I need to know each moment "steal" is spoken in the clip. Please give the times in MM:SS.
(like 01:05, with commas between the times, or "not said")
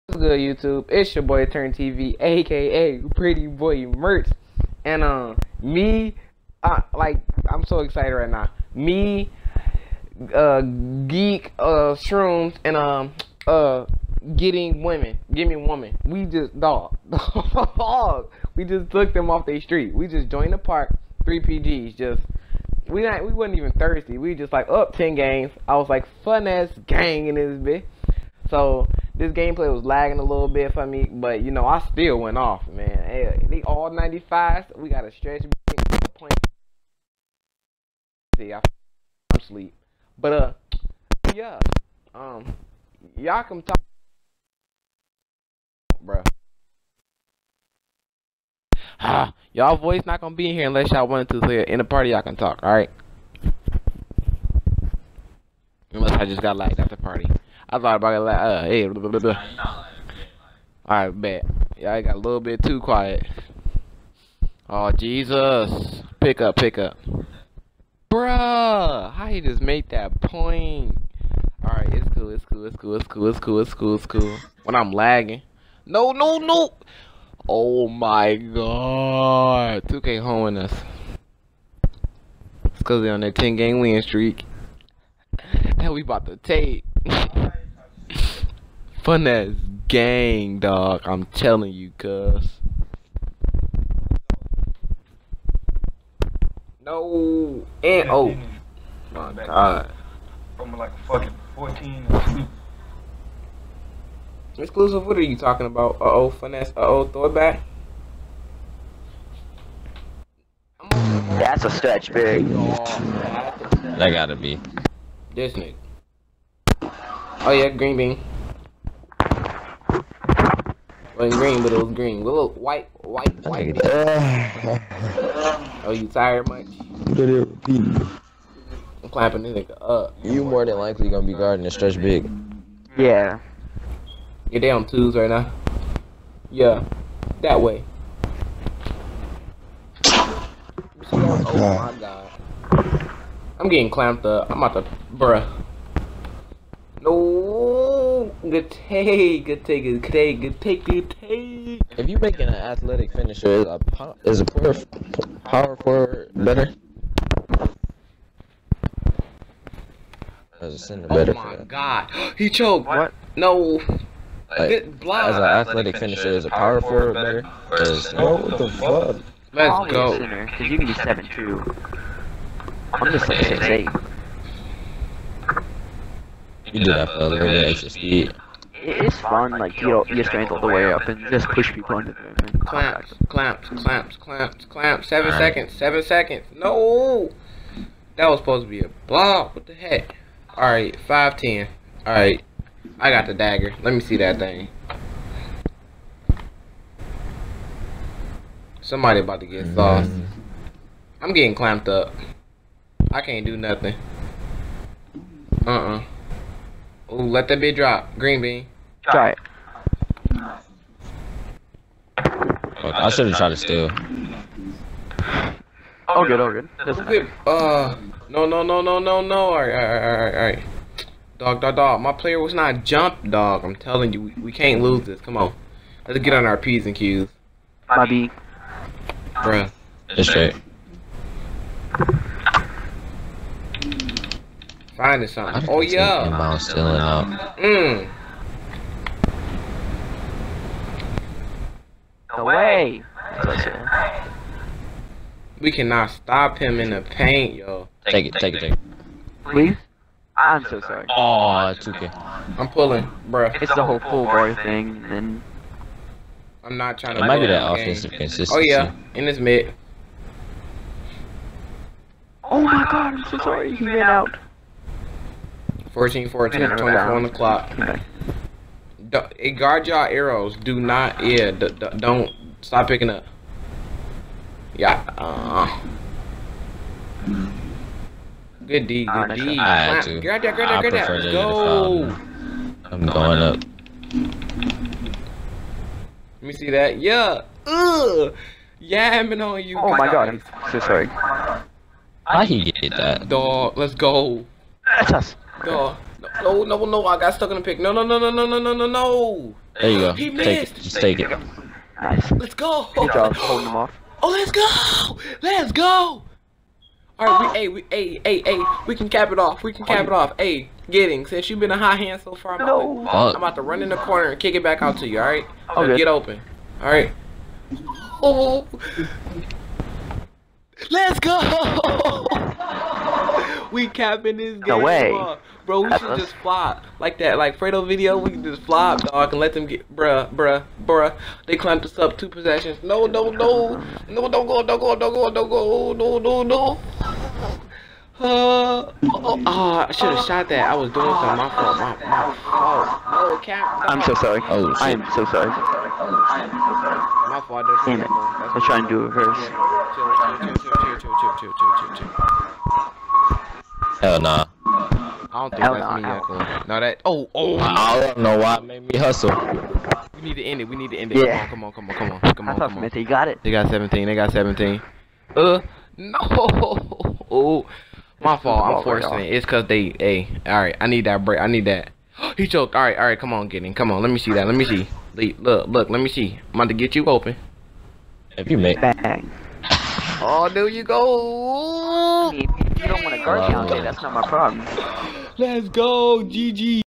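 03:33.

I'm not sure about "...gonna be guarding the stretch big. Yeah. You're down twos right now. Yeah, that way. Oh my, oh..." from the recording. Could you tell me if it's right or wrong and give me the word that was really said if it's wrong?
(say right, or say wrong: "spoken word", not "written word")
right.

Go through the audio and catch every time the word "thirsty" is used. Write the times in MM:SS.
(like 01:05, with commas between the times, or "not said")
00:23.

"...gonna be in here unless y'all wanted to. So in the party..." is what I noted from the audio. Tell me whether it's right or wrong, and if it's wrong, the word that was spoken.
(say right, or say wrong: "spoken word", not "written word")
right.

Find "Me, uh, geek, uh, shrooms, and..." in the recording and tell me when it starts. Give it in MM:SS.
00:08.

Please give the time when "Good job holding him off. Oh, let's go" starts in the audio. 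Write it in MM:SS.
05:02.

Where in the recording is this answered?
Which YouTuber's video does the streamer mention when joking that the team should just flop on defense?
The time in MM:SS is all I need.
05:27.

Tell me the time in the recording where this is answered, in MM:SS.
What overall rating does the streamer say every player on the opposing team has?
00:33.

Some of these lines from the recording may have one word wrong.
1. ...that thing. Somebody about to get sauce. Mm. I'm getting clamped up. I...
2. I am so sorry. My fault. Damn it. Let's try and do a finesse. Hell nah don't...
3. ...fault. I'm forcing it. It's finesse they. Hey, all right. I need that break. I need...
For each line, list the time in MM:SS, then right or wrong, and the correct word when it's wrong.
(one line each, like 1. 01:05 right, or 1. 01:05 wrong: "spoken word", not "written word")
1. 03:14 right
2. 05:44 wrong: "reverse", not "finesse"
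3. 06:08 wrong: "cause", not "finesse".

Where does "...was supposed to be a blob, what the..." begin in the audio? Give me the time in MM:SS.
03:08.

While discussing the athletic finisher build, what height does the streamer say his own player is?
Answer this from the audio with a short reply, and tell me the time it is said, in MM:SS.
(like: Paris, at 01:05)
6'8, at 02:53.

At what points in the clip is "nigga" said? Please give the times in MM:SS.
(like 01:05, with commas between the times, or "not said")
01:55, 02:09.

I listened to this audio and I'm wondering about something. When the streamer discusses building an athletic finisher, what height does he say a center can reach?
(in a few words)
7'2.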